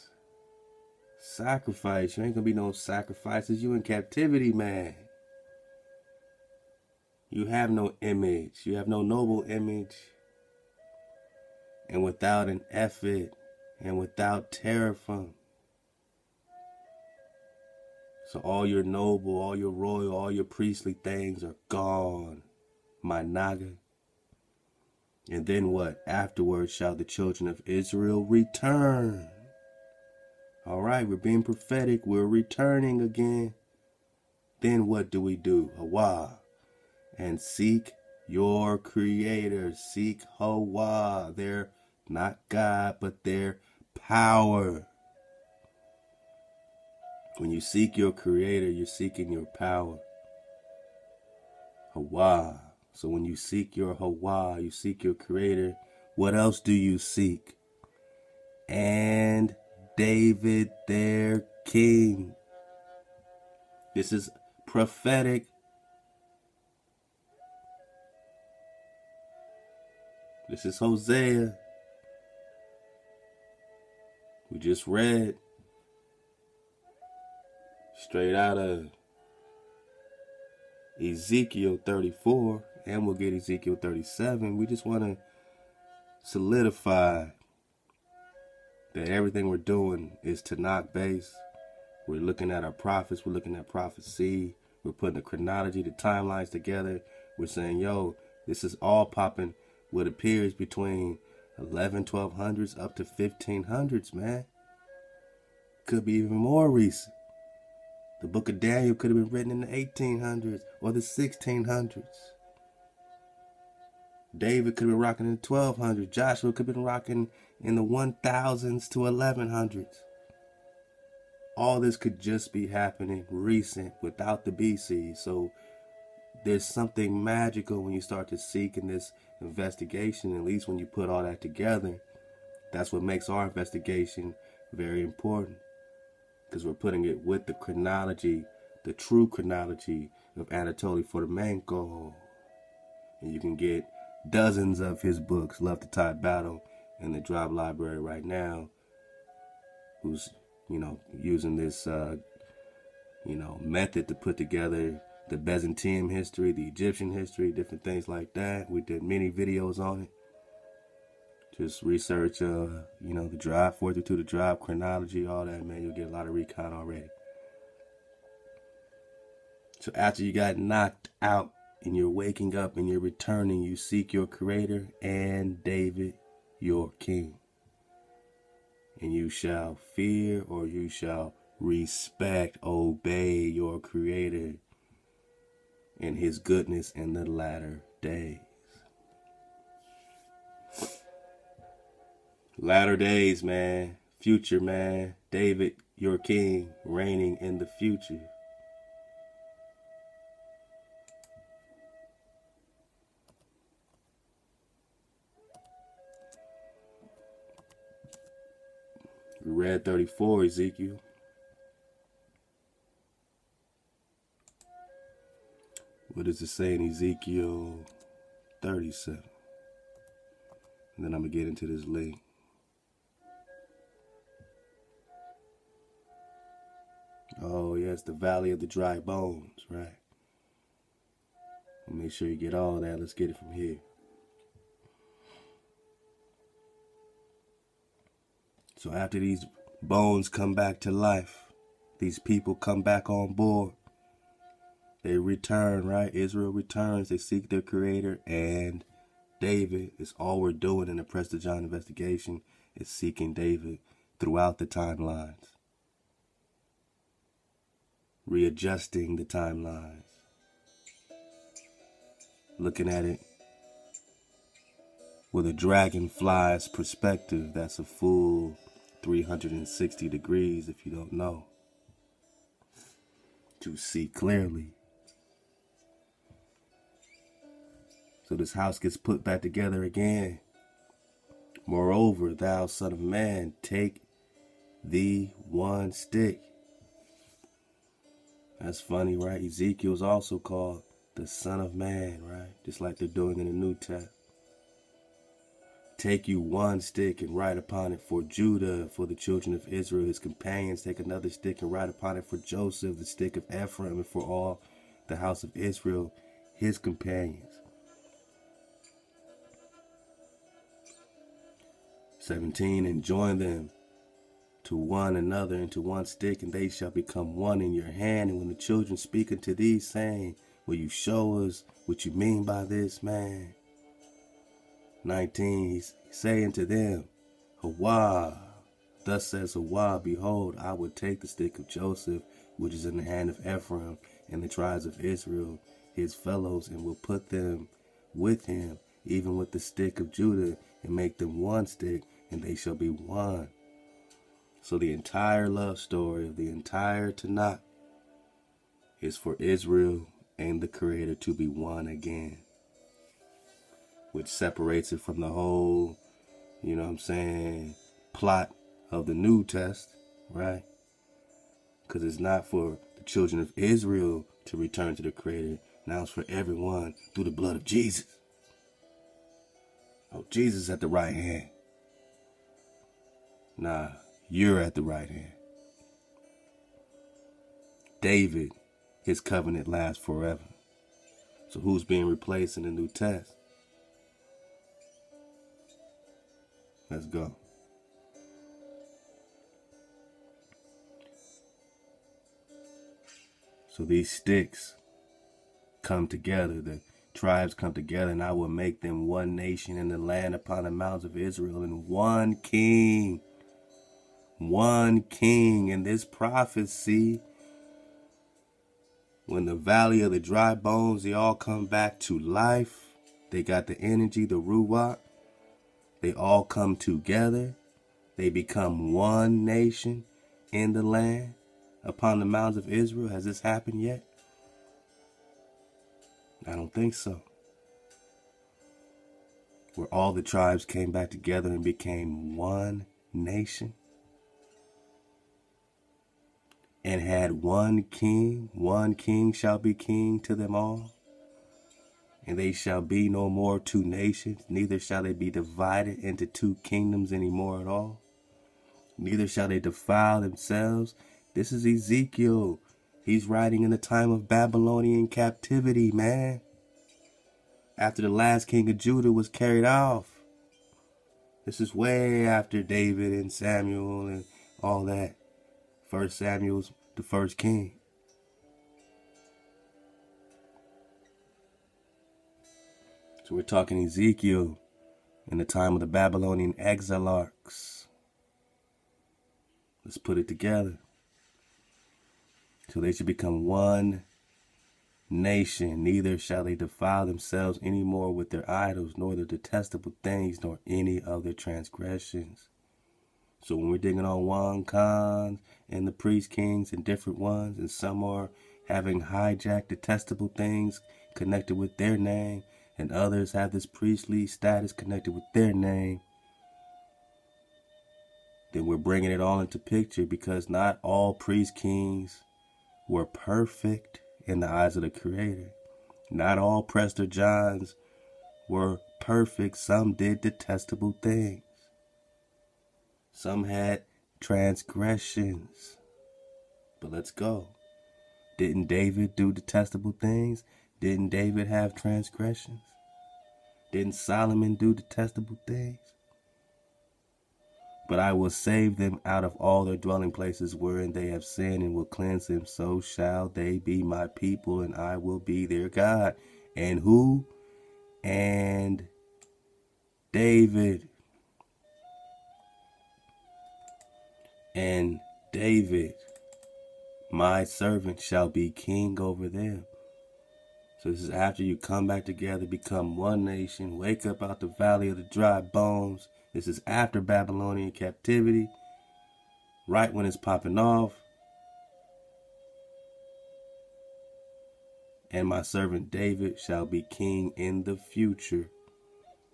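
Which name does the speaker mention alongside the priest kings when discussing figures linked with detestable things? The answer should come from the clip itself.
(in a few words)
Wan Khan.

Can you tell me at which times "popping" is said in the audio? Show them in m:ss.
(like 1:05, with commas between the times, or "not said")
1:39, 9:30.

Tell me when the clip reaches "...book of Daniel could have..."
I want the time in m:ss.
1:48.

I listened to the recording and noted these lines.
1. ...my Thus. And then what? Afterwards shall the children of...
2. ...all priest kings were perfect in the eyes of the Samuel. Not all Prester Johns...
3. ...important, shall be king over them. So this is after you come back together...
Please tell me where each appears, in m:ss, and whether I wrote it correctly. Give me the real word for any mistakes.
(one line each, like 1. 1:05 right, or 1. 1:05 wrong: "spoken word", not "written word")
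1. 0:23 wrong: "Naga", not "Thus"
2. 8:30 wrong: "Creator", not "Samuel"
3. 9:17 wrong: "servant", not "important".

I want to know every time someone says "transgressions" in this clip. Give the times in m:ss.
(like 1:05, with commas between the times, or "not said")
8:11, 8:44, 8:51.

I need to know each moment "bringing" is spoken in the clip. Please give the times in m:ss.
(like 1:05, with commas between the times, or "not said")
8:28.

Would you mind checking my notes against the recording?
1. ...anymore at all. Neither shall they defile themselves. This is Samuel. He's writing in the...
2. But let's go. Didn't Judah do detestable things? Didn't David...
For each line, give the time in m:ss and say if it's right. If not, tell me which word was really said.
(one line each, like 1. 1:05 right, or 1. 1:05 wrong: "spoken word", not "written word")
1. 7:27 wrong: "Ezekiel", not "Samuel"
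2. 8:46 wrong: "David", not "Judah".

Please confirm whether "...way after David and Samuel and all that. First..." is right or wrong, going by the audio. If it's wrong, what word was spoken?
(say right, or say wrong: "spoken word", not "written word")
right.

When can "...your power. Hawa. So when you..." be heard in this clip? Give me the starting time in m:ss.
0:49.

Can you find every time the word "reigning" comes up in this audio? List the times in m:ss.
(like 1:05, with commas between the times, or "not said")
3:16.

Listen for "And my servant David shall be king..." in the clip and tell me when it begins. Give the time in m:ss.
9:35.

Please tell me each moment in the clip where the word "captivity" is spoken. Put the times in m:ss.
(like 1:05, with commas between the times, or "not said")
0:03, 7:35, 9:27.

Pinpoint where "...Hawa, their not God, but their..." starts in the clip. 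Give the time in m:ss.
0:40.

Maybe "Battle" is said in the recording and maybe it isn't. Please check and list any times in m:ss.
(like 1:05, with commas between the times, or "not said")
2:26.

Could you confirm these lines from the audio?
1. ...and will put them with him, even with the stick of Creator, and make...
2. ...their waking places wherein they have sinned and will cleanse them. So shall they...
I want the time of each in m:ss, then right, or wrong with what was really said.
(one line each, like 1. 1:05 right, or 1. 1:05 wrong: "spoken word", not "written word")
1. 5:36 wrong: "Judah", not "Creator"
2. 8:59 wrong: "dwelling", not "waking".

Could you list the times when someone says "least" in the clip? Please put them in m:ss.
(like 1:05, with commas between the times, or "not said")
2:10.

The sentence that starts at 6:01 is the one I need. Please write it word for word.
Because it's not for the children of Israel to return to the Creator.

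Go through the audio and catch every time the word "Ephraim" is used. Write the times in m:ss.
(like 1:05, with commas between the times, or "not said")
5:03, 5:33.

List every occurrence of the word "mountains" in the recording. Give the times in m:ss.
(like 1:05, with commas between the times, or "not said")
6:40, 7:02.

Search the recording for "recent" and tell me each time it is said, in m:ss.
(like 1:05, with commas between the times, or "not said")
1:46, 2:03.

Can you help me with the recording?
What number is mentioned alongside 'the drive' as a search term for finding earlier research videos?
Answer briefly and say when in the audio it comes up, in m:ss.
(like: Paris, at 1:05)
432, at 2:43.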